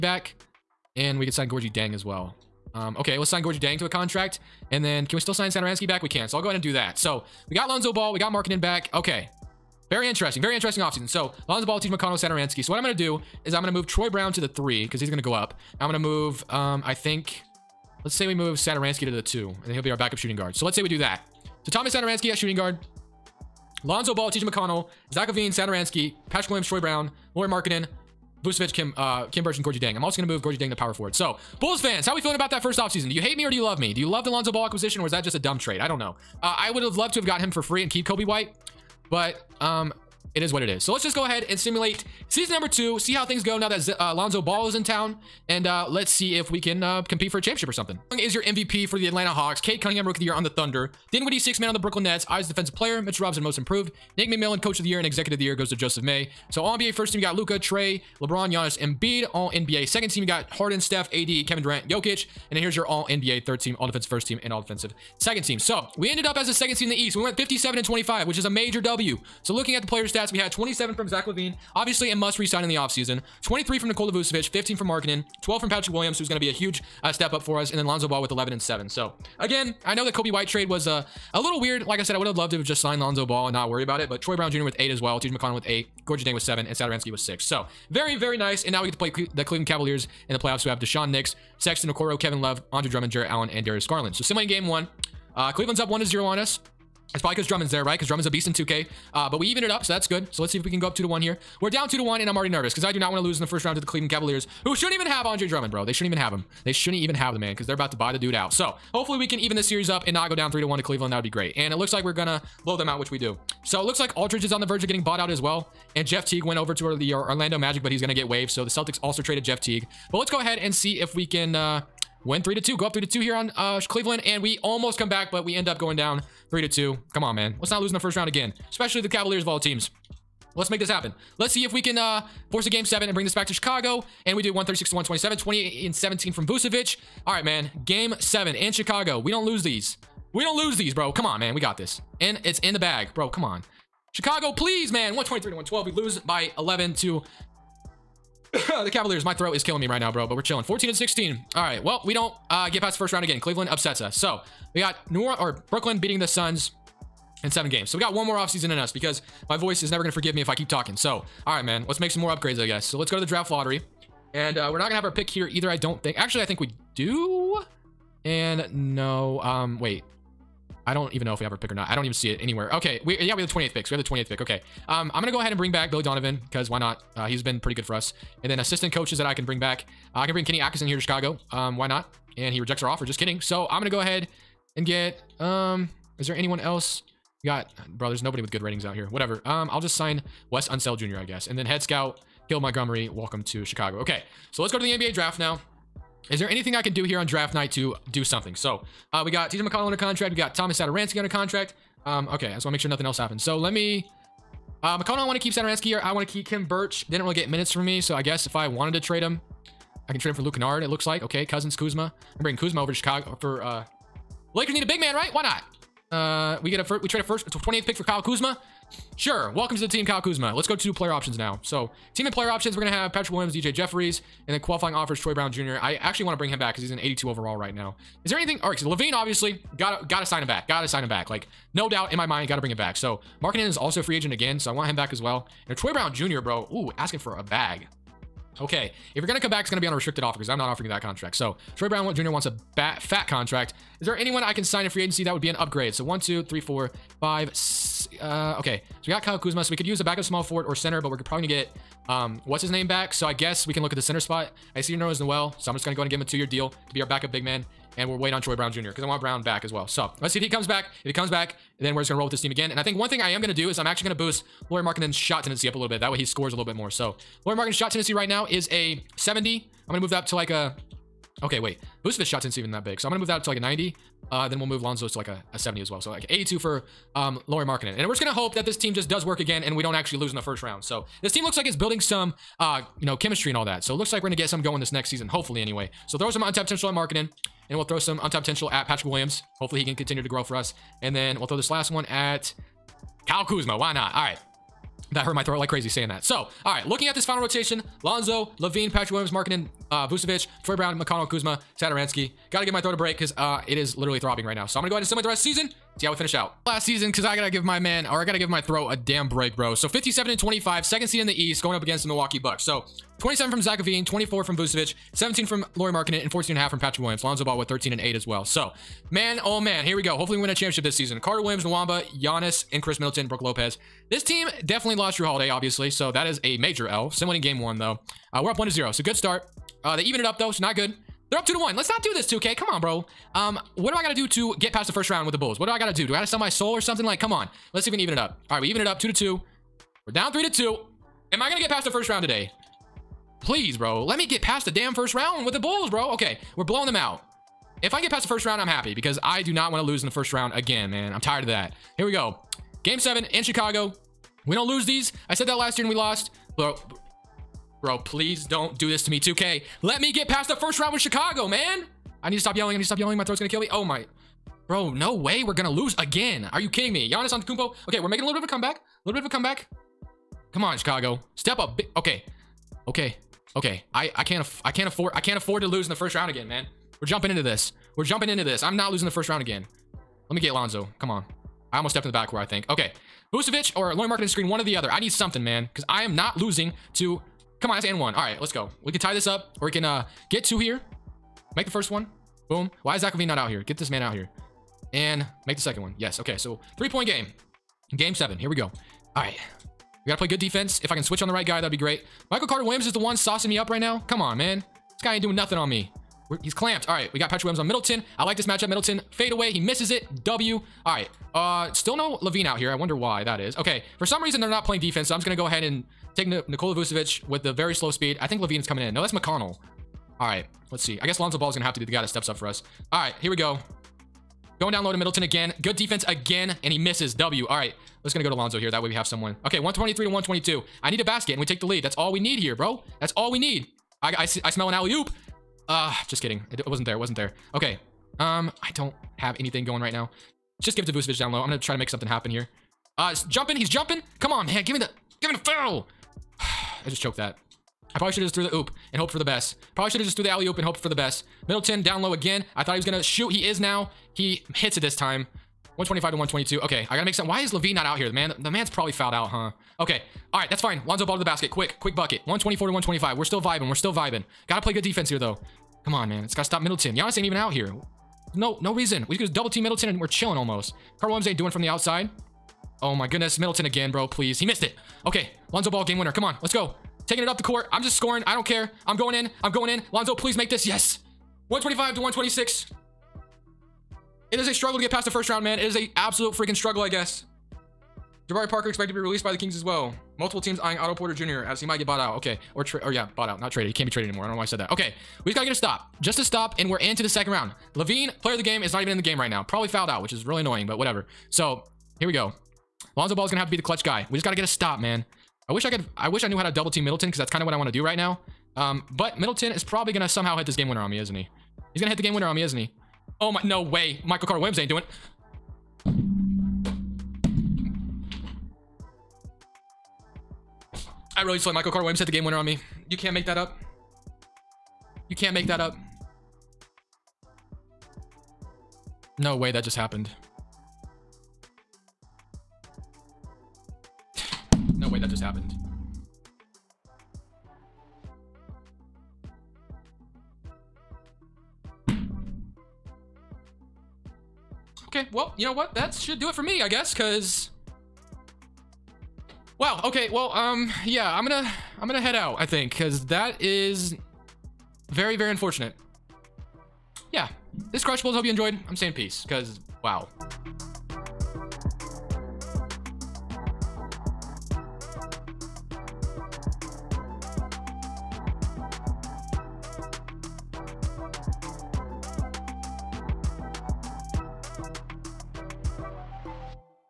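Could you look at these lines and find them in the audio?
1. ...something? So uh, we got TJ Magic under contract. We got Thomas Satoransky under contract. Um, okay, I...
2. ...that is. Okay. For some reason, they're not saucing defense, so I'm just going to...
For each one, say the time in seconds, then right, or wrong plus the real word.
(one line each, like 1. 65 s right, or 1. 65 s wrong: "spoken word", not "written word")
1. 198 s wrong: "McConnell", not "Magic"
2. 413 s wrong: "playing", not "saucing".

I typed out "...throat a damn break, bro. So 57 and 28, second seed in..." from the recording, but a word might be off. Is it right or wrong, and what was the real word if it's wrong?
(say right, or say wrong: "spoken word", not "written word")
wrong: "25", not "28".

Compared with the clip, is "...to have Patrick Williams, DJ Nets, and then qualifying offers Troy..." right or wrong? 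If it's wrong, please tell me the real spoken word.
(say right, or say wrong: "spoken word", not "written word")
wrong: "Jeffries", not "Nets".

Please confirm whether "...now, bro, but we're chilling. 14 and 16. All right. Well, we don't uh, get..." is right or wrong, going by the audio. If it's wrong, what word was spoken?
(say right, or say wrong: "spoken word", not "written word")
right.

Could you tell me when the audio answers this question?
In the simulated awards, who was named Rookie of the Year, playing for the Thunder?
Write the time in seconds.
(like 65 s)
49 s.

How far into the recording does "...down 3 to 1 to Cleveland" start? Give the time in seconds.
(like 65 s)
110 s.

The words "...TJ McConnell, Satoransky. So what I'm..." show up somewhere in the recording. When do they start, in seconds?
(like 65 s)
11 s.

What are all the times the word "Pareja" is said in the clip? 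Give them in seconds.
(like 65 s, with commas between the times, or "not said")
not said.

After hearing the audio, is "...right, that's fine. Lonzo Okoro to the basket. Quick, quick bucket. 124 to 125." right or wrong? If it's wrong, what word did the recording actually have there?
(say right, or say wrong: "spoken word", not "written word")
wrong: "Ball", not "Okoro".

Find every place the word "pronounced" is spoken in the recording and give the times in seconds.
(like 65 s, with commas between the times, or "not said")
not said.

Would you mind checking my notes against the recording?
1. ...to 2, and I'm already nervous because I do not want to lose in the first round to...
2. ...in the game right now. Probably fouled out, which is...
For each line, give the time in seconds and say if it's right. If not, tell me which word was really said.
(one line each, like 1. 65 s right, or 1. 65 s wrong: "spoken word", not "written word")
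1. 101 s wrong: "1", not "2"
2. 498 s right.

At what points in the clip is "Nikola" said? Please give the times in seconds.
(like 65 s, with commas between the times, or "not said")
73 s, 416 s.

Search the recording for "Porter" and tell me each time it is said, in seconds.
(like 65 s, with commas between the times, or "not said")
490 s.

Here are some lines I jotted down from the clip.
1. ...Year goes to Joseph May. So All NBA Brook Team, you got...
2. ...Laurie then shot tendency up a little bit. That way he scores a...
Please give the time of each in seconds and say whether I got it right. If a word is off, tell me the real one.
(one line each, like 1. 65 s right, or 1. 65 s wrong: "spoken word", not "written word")
1. 55 s wrong: "First", not "Brook"
2. 264 s right.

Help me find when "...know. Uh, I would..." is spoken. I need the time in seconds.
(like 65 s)
35 s.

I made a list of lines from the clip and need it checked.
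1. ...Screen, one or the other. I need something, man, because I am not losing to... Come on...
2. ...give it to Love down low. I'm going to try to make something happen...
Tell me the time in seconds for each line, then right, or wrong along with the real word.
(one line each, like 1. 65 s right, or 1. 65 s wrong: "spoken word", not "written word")
1. 384 s right
2. 440 s wrong: "Vucevic", not "Love".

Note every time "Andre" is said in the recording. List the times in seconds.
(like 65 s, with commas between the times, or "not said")
92 s, 105 s.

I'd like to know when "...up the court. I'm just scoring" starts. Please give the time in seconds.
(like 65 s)
477 s.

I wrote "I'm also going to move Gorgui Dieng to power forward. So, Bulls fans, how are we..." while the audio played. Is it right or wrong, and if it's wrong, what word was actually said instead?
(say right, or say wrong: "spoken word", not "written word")
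right.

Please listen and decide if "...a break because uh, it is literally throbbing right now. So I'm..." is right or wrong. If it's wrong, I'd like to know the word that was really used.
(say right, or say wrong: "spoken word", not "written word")
right.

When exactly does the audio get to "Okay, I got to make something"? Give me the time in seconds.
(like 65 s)
456 s.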